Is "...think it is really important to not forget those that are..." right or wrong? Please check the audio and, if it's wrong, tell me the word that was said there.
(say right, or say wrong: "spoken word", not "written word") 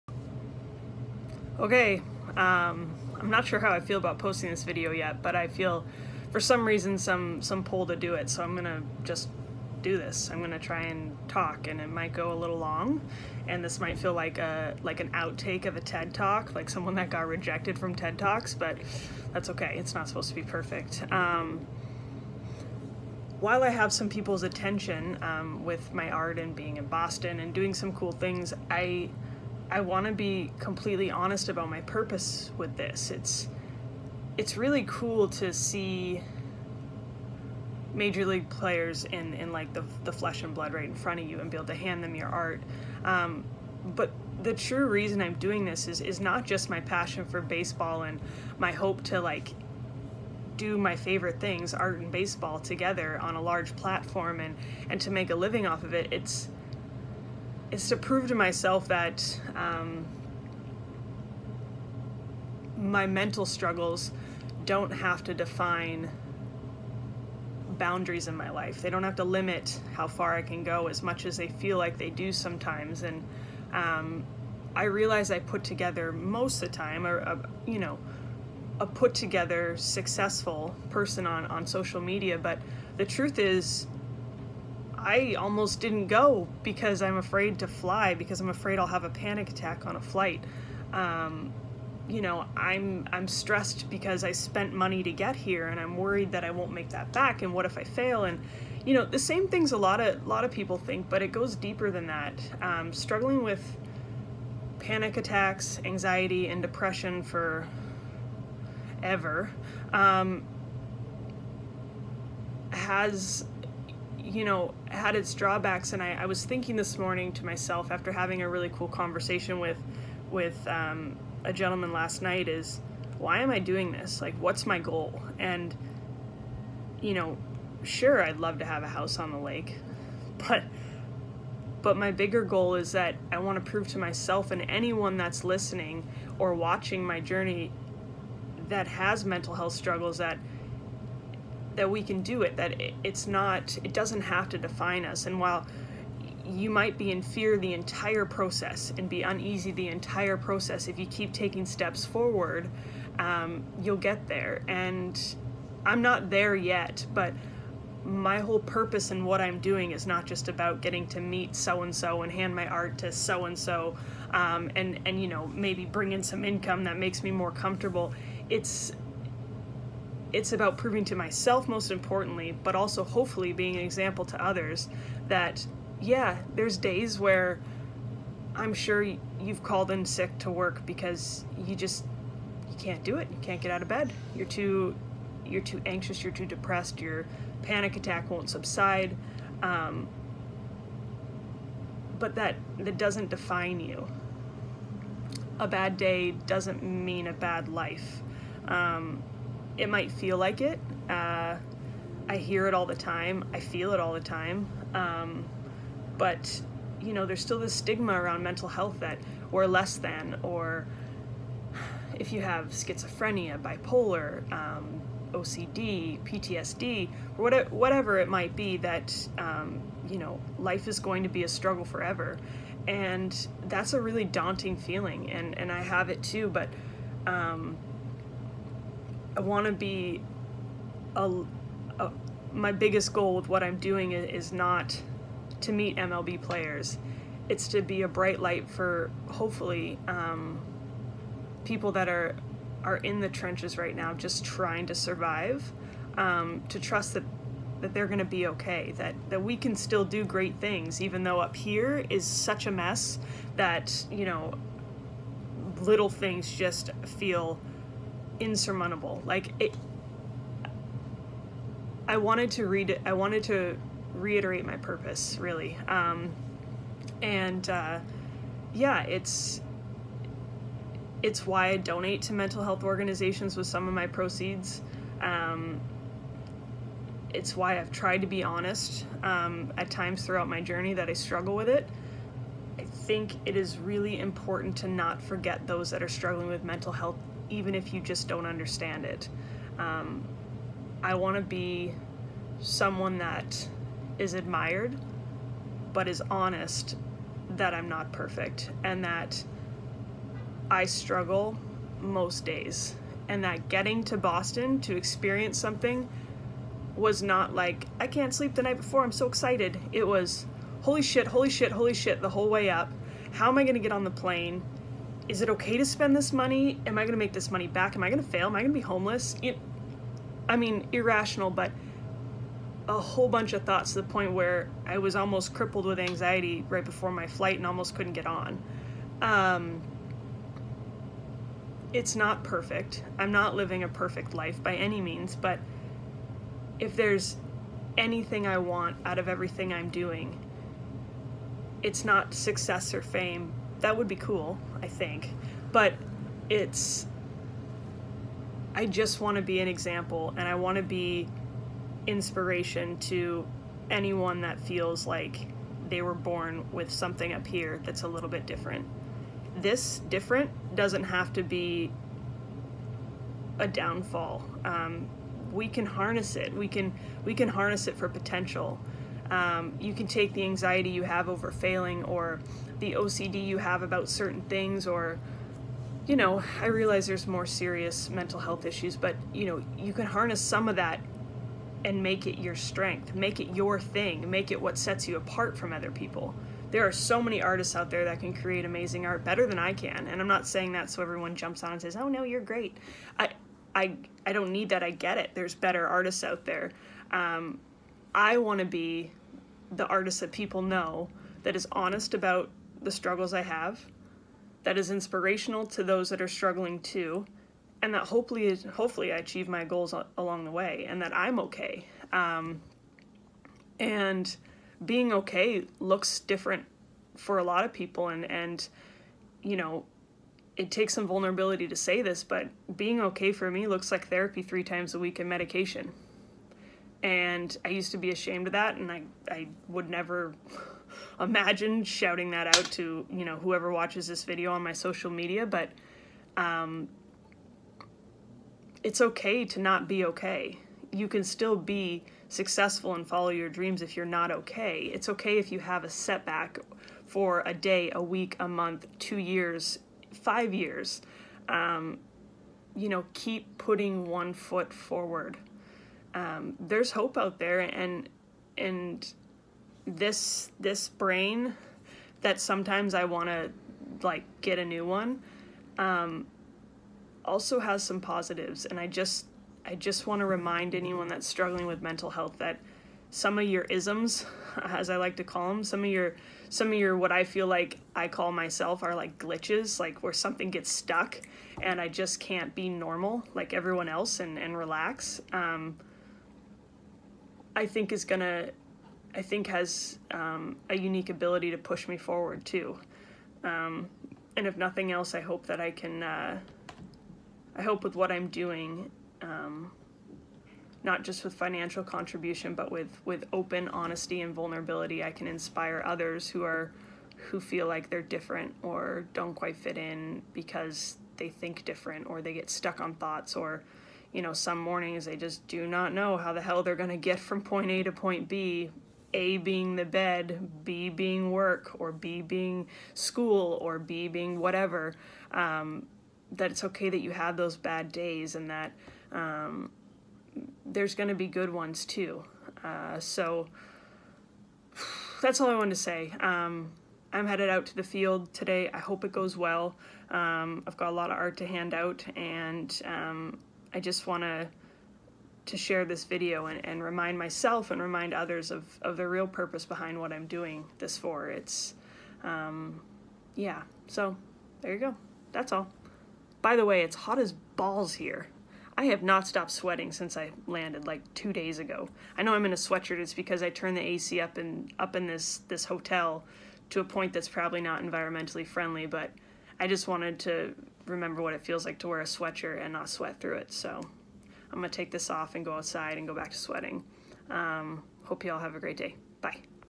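right.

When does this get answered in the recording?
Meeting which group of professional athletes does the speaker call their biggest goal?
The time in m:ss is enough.
3:55.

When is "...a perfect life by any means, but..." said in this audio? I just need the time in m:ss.
5:33.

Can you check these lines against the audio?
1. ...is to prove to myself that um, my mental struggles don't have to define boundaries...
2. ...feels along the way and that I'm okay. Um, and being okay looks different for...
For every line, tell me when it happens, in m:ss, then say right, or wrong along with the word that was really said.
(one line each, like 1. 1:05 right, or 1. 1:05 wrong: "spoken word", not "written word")
1. 0:57 right
2. 6:49 wrong: "goals", not "feels".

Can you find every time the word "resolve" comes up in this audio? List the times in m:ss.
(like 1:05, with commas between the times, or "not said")
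not said.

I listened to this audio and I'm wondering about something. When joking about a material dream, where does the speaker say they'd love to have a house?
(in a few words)
On the lake.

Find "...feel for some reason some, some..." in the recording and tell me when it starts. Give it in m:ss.
0:05.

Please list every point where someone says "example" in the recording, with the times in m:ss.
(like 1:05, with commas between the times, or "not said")
2:53, 5:49.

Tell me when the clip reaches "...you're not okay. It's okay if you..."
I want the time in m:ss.
7:23.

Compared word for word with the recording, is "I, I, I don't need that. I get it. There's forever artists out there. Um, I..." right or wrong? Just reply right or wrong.
wrong.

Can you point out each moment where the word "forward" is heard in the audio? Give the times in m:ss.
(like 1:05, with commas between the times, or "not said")
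2:32, 7:34, 8:11.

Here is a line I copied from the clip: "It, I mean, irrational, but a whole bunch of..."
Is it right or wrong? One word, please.
right.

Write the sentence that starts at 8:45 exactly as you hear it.
Um, that it's okay that you have those bad days and that um, there's going to be good ones too.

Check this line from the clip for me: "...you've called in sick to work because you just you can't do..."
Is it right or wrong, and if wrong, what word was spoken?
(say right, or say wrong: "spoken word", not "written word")
right.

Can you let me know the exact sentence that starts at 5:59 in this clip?
This different doesn't have to be a downfall.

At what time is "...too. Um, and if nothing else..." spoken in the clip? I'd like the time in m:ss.
8:12.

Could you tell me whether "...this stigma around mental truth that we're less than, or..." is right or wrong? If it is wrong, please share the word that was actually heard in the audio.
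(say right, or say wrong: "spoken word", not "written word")
wrong: "health", not "truth".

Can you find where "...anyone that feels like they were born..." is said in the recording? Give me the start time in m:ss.
5:53.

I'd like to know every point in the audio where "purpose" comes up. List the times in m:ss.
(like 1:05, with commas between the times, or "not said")
0:31, 2:38, 4:24, 9:09.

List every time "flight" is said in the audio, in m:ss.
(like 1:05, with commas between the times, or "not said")
1:30, 5:27.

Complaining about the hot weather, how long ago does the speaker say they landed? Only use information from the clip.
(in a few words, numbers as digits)
2 days ago.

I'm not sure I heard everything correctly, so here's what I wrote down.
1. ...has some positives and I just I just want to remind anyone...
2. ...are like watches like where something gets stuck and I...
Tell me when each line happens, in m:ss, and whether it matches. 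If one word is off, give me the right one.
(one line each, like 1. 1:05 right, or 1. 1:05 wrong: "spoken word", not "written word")
1. 7:47 right
2. 7:58 wrong: "glitches", not "watches".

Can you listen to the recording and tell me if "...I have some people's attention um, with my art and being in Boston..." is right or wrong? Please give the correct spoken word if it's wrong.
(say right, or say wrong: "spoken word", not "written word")
right.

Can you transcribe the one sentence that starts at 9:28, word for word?
But I just wanted to remember what it feels like to wear a sweatshirt and not sweat through it.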